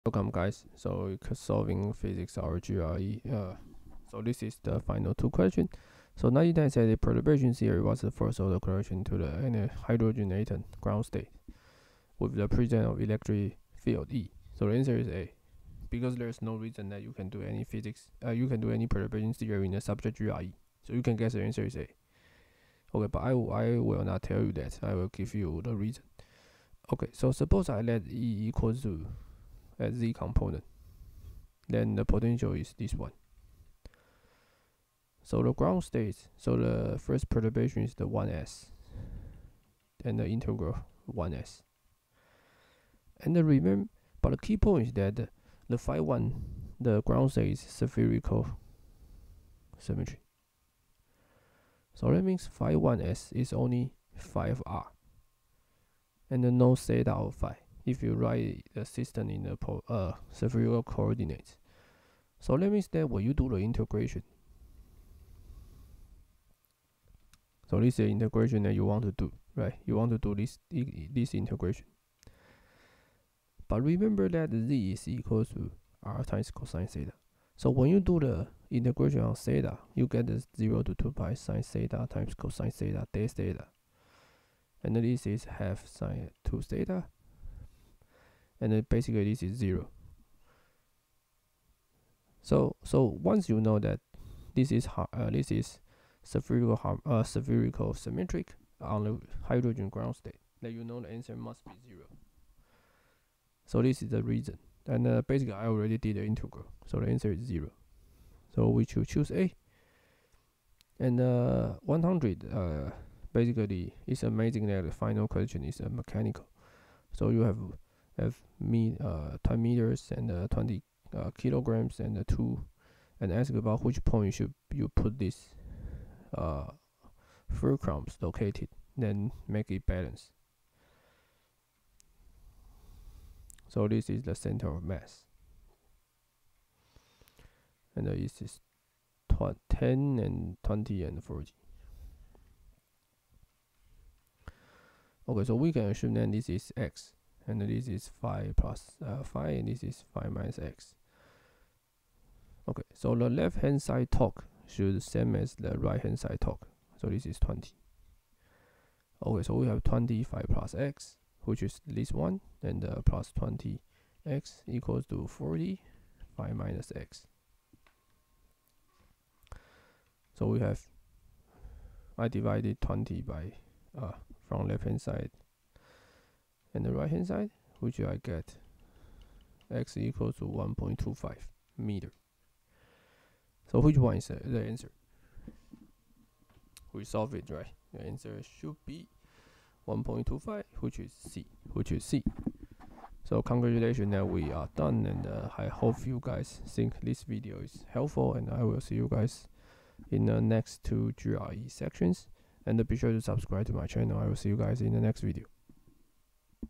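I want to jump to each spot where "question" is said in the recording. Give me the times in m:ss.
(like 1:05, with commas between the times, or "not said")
0:05, 1:55.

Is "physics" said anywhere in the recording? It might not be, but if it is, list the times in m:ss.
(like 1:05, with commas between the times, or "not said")
0:01, 0:17.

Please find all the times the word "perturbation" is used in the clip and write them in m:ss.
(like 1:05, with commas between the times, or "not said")
0:06, 0:18, 0:37.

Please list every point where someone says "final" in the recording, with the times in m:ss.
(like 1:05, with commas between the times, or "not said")
0:04, 1:54.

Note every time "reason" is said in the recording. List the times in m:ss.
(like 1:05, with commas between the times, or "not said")
0:16, 0:25, 1:44.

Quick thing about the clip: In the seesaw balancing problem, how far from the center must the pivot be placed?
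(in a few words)
1.25 meters.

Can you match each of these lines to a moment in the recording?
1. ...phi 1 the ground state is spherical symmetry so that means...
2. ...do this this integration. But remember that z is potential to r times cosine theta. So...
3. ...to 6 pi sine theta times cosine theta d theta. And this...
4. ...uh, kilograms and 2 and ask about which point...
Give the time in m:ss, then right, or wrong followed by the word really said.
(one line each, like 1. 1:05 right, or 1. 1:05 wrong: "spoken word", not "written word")
1. 0:45 right
2. 1:10 wrong: "equal", not "potential"
3. 1:20 wrong: "2", not "6"
4. 2:01 right.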